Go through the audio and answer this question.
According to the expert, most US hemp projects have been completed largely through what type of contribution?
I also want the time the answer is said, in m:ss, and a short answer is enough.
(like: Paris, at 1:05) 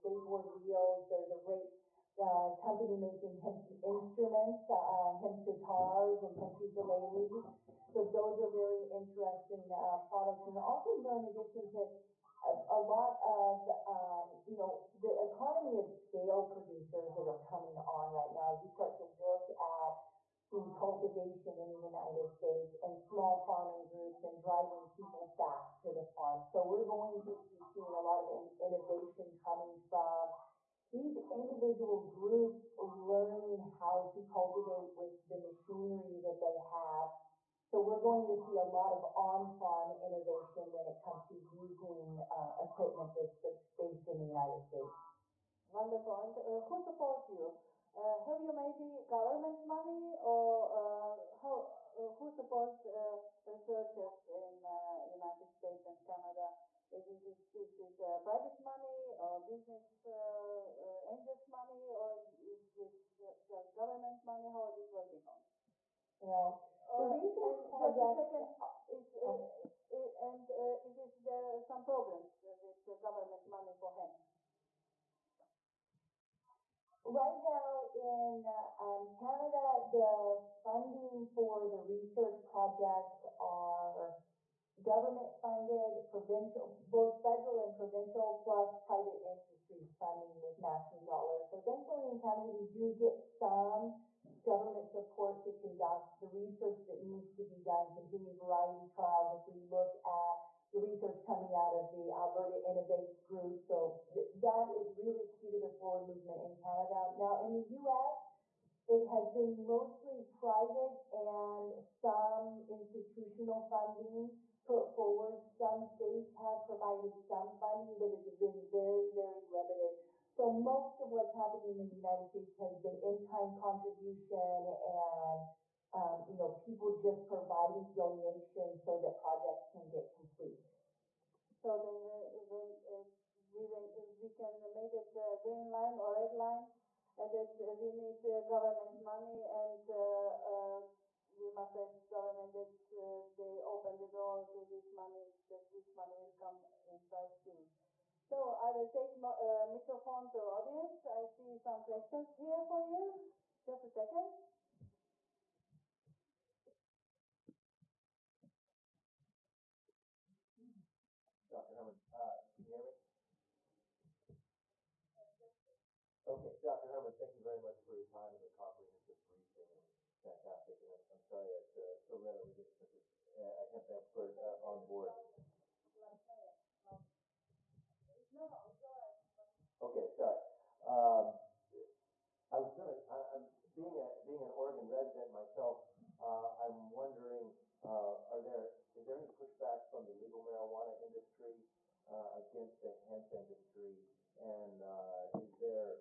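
In-kind contribution, at 2:02.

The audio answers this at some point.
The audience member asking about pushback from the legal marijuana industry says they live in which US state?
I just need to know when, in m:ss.
3:04.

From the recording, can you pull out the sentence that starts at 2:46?
Hermann, thank you very much for your time and the comprehensive briefing.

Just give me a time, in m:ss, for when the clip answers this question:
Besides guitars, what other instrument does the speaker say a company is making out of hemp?
0:06.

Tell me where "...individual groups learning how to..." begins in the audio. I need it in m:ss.
0:31.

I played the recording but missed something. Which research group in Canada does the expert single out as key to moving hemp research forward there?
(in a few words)
Alberta Innovates.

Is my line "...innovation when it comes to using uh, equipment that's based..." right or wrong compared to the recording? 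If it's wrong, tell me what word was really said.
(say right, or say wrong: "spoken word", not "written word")
right.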